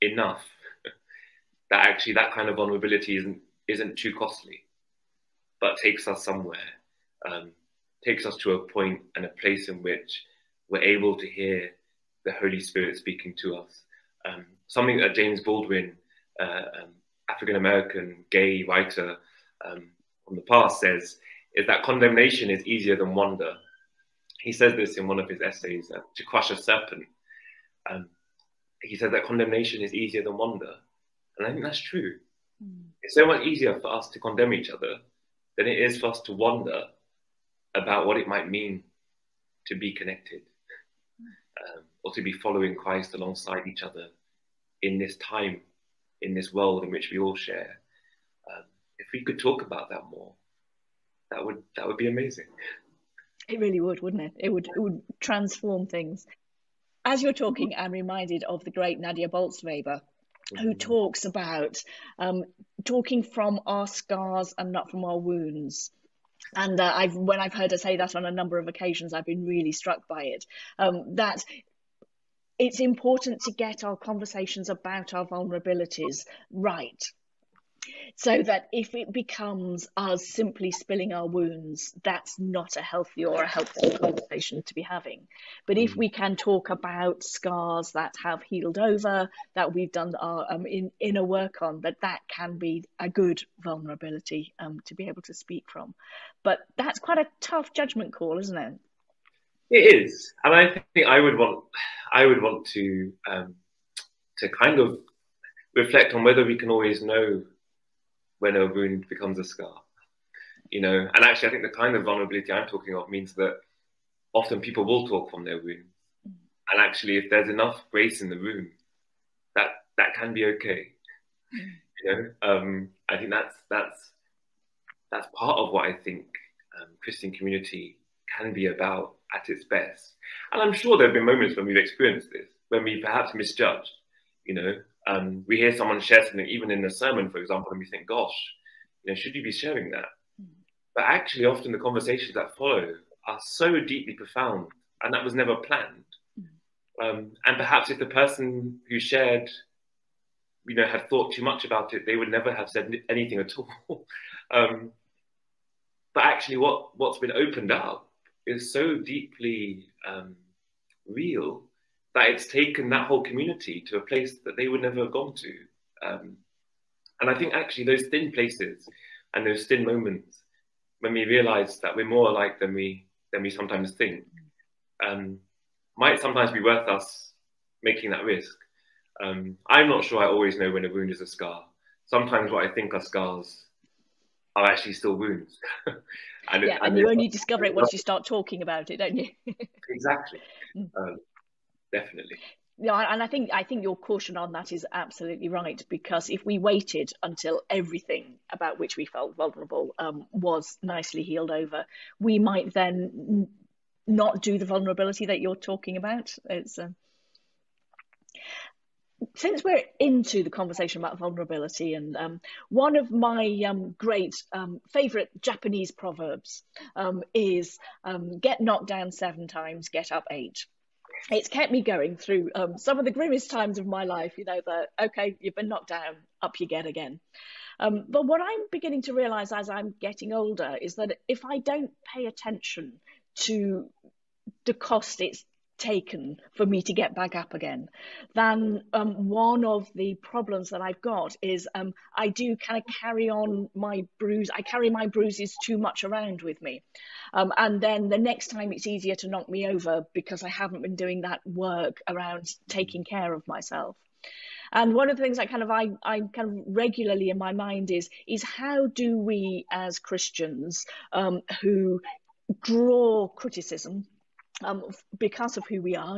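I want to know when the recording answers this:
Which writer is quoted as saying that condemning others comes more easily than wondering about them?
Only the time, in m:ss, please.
0:15.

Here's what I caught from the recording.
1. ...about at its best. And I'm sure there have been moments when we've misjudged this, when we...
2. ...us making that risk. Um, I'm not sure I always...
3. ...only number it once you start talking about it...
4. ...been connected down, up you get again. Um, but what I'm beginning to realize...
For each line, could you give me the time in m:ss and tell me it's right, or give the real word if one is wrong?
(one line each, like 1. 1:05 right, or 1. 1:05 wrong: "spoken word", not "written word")
1. 2:08 wrong: "experienced", not "misjudged"
2. 2:56 right
3. 3:07 wrong: "discover", not "number"
4. 3:45 wrong: "knocked", not "connected".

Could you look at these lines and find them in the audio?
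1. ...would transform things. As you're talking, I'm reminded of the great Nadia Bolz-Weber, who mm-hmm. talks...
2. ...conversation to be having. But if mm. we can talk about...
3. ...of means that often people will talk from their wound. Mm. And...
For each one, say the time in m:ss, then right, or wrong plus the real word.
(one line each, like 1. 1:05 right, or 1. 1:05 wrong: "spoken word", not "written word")
1. 0:54 right
2. 1:23 right
3. 1:52 right.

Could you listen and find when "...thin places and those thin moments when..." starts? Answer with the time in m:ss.
2:48.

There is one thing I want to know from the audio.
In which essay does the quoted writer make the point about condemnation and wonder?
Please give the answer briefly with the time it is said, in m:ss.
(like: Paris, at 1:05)
To Crush a Serpent, at 0:26.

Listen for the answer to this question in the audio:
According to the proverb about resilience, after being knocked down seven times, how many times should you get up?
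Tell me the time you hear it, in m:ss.
3:40.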